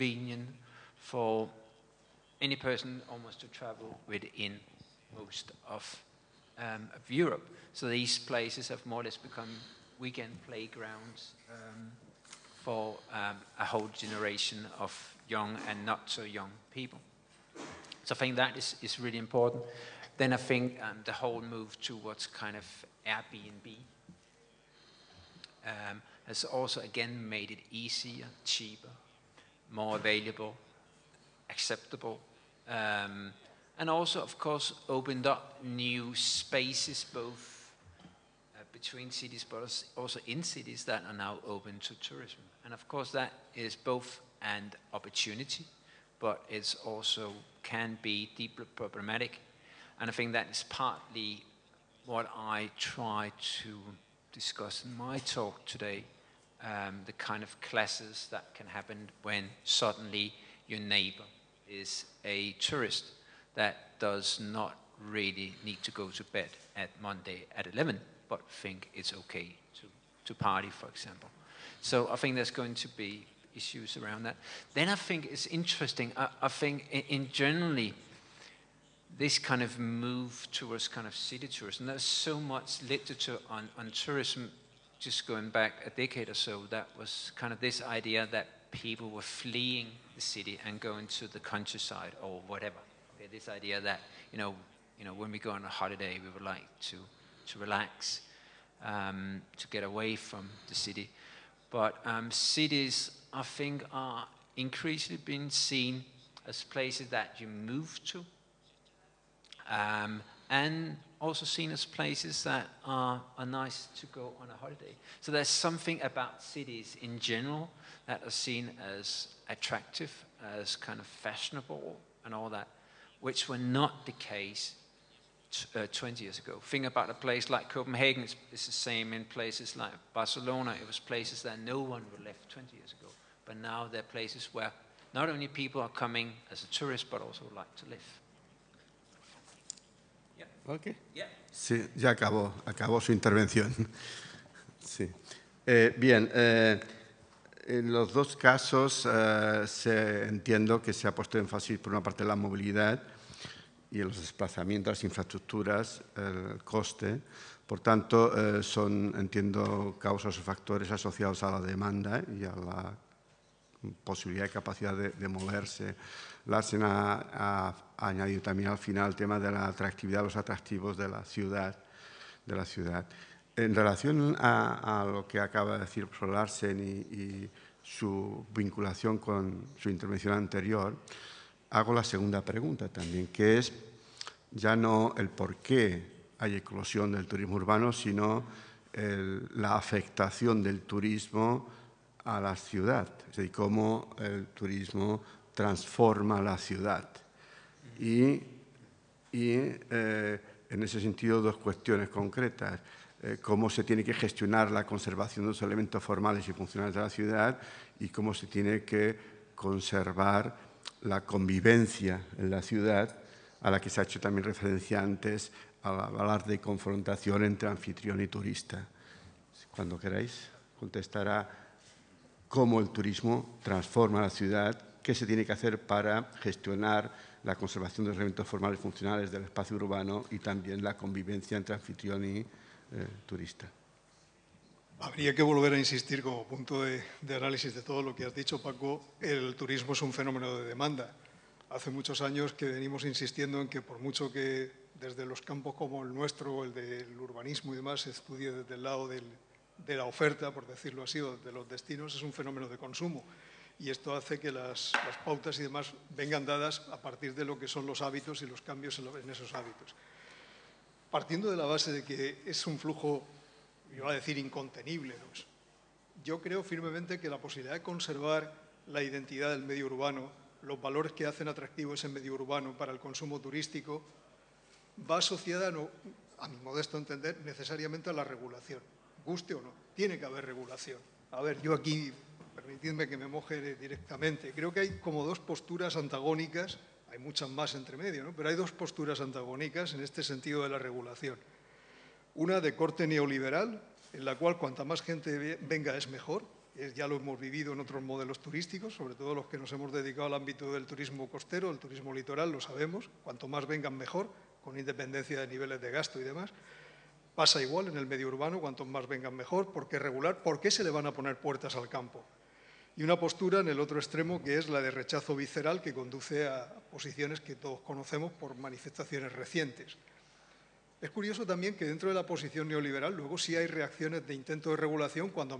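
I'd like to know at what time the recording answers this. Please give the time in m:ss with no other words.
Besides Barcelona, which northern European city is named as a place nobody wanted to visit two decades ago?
2:07.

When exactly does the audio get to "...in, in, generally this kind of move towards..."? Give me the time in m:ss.
1:16.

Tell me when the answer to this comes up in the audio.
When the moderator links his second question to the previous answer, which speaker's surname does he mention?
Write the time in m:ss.
2:56.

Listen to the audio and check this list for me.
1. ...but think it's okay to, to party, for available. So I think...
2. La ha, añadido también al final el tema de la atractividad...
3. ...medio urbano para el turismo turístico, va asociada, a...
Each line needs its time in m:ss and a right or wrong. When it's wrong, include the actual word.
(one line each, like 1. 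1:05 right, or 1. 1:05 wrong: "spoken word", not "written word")
1. 1:08 wrong: "example", not "available"
2. 2:46 right
3. 4:32 wrong: "consumo", not "turismo".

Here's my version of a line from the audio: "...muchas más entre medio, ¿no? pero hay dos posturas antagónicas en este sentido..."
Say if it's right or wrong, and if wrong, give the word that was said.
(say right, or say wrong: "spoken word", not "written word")
right.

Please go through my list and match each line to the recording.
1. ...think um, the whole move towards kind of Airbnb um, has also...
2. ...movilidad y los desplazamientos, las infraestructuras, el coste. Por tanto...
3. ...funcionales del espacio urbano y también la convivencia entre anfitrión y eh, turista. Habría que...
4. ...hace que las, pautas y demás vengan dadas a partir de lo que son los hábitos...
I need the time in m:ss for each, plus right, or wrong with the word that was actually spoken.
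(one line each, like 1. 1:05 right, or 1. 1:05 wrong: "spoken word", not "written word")
1. 0:20 right
2. 2:32 right
3. 3:48 right
4. 4:14 right.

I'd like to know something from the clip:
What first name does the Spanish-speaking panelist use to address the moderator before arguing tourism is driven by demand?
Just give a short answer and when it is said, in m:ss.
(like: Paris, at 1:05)
Paco, at 3:58.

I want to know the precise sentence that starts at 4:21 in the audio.
Partiendo de la base de que es un flujo yo iba a decir incontenible.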